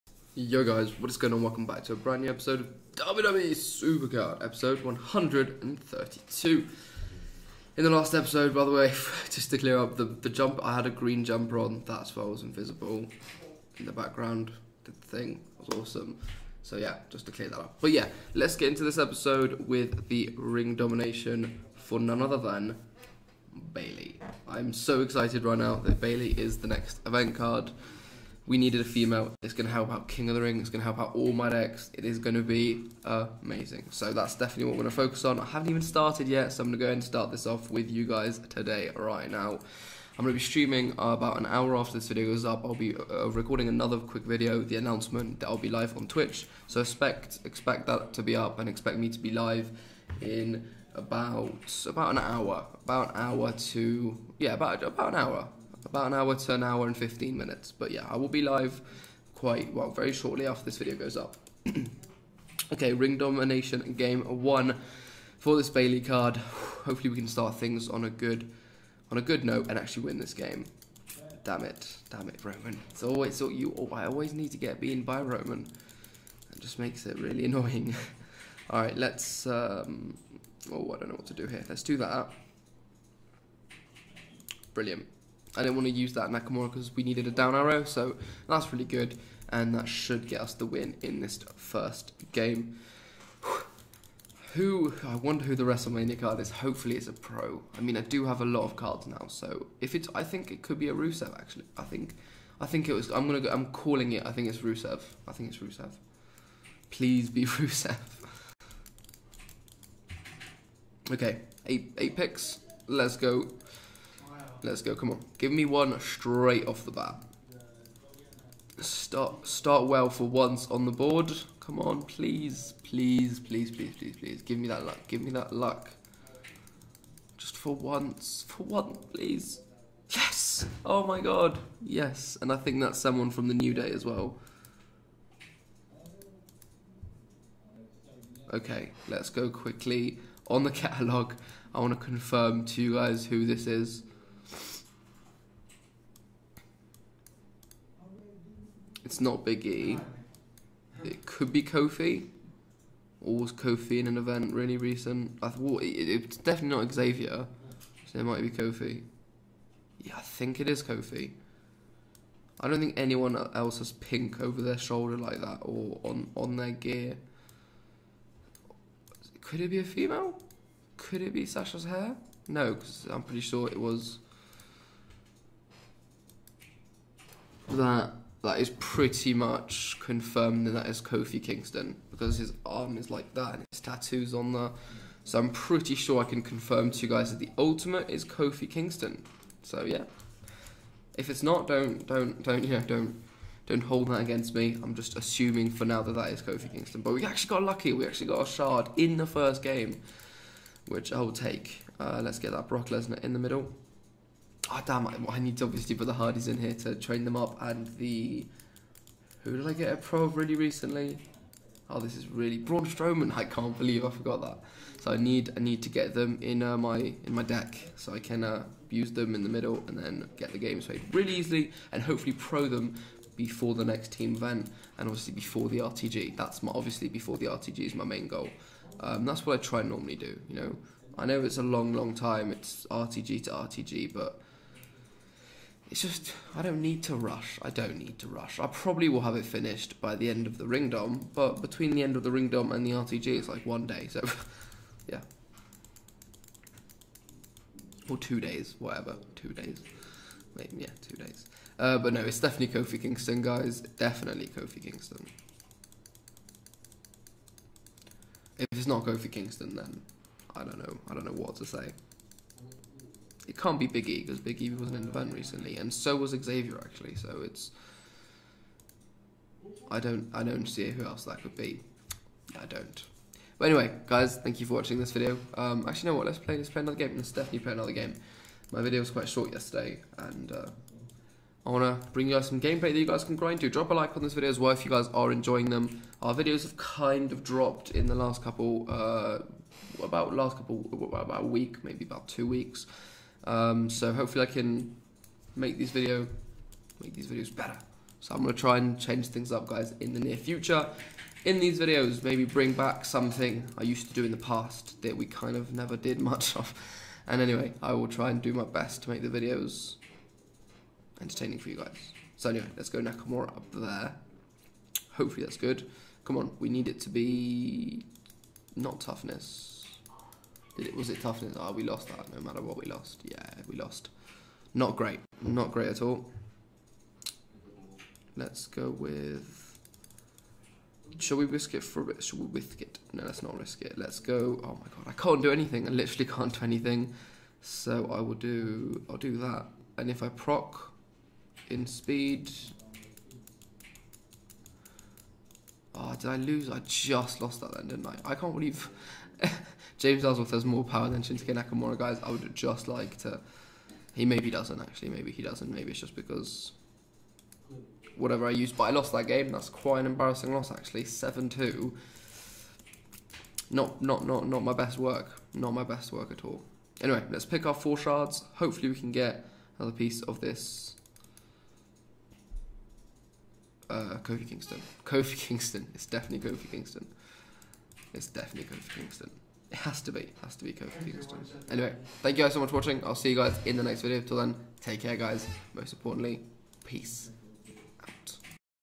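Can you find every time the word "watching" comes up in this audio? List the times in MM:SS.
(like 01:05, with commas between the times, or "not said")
04:34, 06:22.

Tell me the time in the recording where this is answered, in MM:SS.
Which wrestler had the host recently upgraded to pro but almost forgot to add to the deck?
03:32.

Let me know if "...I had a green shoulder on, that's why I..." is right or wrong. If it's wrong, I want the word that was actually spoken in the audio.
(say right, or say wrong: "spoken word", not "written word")
wrong: "jumper", not "shoulder".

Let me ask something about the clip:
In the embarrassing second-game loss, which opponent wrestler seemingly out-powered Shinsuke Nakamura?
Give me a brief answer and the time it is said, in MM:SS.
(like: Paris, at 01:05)
James Ellsworth, at 05:50.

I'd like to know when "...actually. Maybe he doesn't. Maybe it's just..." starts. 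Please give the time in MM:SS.
05:54.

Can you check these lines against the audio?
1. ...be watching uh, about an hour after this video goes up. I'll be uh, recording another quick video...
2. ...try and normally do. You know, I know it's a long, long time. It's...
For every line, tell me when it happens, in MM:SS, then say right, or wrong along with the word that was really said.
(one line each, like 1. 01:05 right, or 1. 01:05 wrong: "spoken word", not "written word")
1. 00:40 wrong: "streaming", not "watching"
2. 03:49 right.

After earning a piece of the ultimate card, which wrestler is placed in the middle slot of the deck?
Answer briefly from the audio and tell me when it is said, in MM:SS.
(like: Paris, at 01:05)
Brock Lesnar, at 03:22.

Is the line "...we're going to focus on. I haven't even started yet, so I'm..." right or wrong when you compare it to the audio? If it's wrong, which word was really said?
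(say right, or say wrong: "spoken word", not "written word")
right.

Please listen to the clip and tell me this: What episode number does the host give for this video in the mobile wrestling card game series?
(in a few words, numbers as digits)
132.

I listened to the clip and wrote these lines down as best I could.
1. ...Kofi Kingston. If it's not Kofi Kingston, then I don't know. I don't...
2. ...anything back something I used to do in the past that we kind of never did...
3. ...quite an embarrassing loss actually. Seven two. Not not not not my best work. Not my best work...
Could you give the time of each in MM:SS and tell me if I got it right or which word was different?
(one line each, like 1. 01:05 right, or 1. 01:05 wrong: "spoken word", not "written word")
1. 04:14 right
2. 05:02 wrong: "bring", not "anything"
3. 05:59 right.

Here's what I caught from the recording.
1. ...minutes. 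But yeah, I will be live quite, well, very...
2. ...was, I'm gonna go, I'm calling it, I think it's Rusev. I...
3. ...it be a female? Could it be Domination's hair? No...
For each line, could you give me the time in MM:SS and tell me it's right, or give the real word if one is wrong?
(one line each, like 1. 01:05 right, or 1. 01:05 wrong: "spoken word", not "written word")
1. 00:57 right
2. 01:42 right
3. 02:49 wrong: "Sasha", not "Domination".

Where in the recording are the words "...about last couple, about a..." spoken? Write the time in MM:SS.
04:50.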